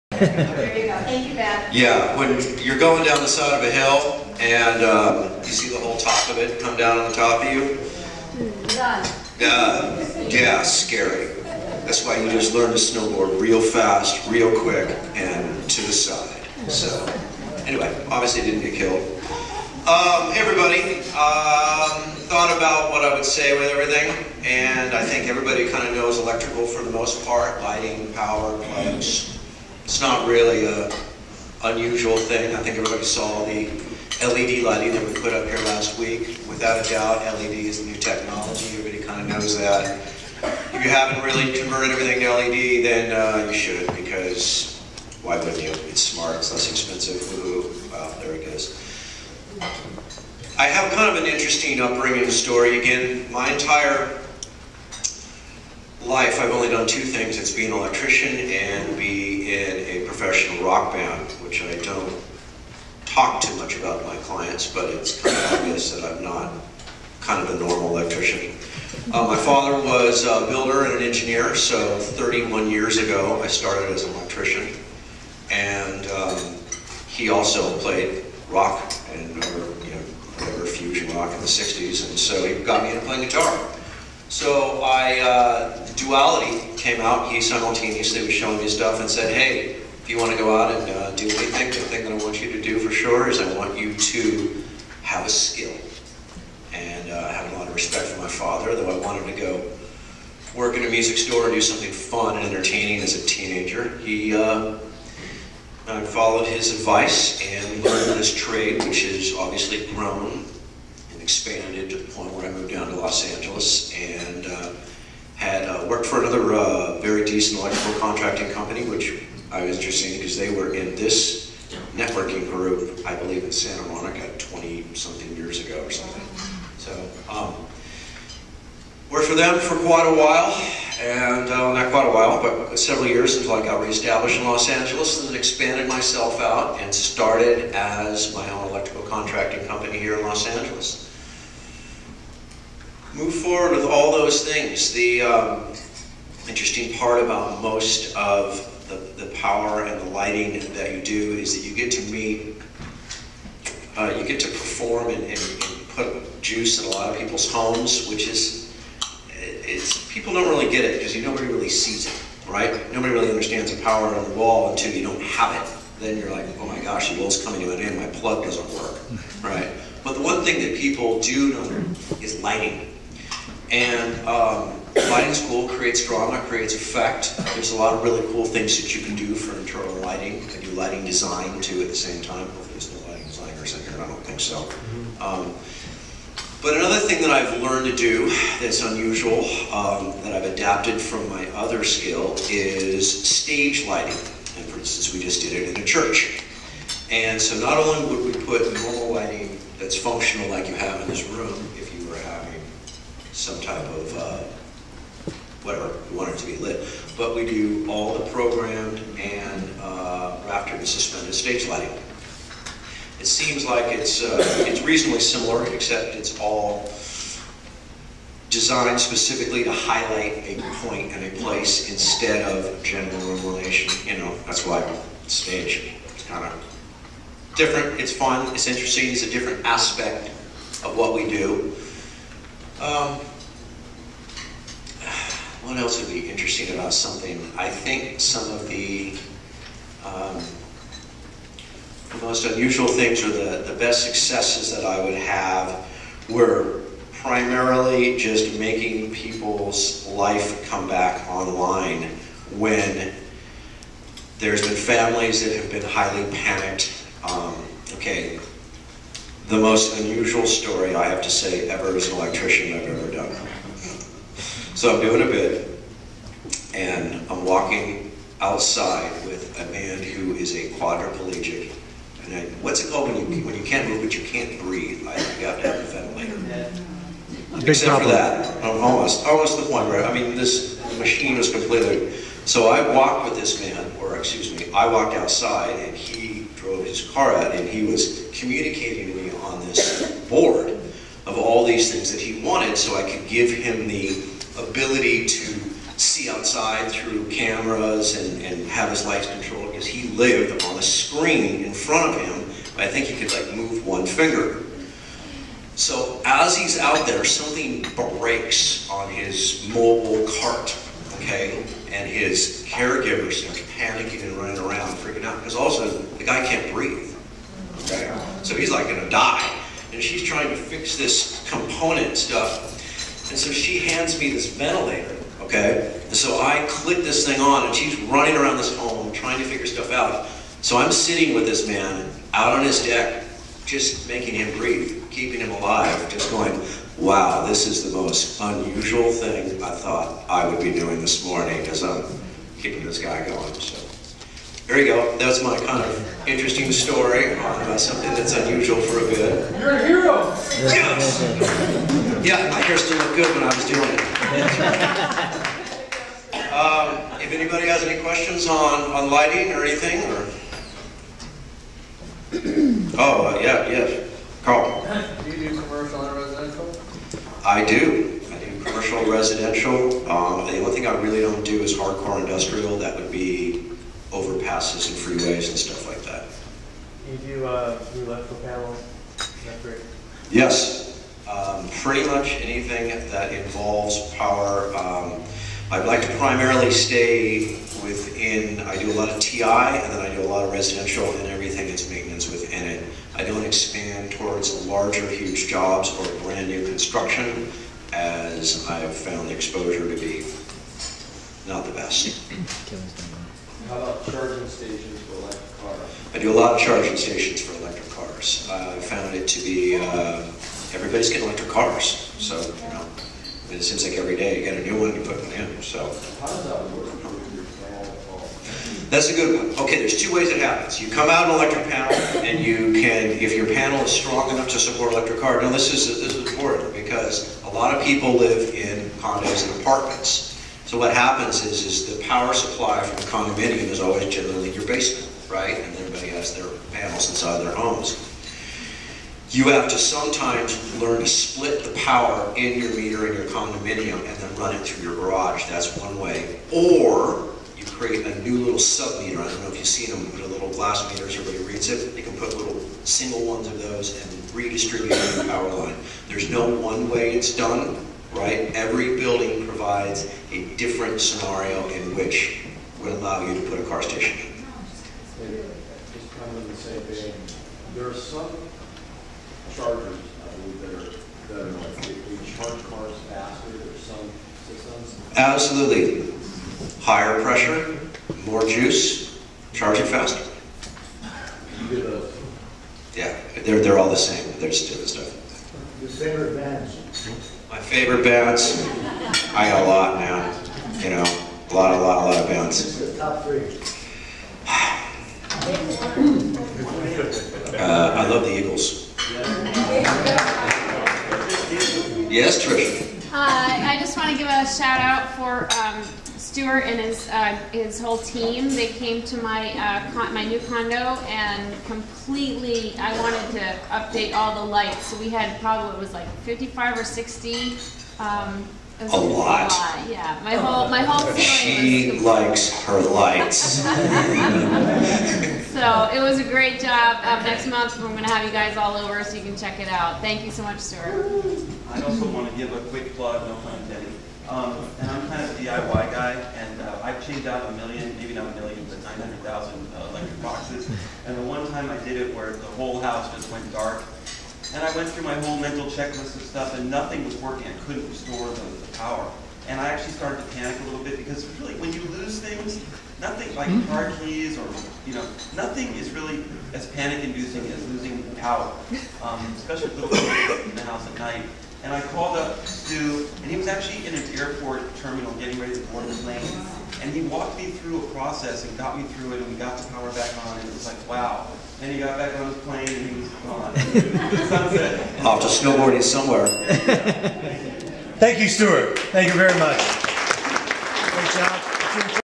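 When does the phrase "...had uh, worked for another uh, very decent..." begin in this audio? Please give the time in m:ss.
1:55.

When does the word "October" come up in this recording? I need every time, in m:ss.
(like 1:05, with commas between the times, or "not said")
not said.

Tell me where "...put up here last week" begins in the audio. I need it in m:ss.
0:35.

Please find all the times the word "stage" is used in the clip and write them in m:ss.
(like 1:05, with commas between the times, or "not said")
3:13, 3:31, 3:45.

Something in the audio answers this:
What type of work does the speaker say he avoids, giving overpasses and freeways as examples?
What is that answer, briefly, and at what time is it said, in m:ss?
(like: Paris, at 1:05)
Hardcore industrial, at 6:11.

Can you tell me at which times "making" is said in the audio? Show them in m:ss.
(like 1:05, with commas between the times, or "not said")
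4:08, 5:34.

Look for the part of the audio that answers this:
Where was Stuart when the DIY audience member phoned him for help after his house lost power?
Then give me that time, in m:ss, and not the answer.
9:24.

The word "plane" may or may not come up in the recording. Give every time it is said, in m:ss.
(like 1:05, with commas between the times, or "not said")
9:26, 9:32.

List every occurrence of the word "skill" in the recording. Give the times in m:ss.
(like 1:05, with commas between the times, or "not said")
1:35, 3:11.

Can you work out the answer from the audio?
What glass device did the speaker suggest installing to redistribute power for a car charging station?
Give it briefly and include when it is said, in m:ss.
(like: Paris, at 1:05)
Sub-meter, at 7:28.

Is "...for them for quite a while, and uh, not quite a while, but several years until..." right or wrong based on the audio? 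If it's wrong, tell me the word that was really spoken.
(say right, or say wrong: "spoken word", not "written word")
right.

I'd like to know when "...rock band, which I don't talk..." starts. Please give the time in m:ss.
1:00.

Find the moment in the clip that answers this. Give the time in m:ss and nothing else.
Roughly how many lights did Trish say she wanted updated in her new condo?
8:36.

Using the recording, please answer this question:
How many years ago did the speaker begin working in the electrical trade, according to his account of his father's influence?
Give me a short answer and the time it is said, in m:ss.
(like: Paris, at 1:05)
31, at 1:11.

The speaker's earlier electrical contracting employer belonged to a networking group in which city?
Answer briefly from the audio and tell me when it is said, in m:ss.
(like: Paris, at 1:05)
Santa Monica, at 2:03.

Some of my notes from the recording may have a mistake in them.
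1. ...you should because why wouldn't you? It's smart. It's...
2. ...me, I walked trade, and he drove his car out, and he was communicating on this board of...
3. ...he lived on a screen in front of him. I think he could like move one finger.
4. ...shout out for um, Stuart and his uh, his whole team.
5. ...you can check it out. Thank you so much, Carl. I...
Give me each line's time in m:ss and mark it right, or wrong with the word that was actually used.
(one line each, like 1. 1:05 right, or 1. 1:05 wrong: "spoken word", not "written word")
1. 0:43 right
2. 4:44 wrong: "outside", not "trade"
3. 4:59 right
4. 8:24 right
5. 8:49 wrong: "Stuart", not "Carl".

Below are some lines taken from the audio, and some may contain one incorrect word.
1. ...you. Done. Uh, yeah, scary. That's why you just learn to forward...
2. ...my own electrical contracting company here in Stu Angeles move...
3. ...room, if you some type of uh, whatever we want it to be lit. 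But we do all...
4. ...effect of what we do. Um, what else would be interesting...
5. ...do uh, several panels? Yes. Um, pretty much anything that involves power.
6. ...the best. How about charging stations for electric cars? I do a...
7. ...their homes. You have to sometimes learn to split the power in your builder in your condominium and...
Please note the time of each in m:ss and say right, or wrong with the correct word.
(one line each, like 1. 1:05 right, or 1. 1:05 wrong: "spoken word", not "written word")
1. 0:07 wrong: "snowboard", not "forward"
2. 2:18 wrong: "Los", not "Stu"
3. 3:21 right
4. 3:49 wrong: "aspect", not "effect"
5. 6:17 wrong: "electrical", not "several"
6. 6:41 right
7. 7:17 wrong: "meter", not "builder".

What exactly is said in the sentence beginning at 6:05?
Do you do commercial and residential?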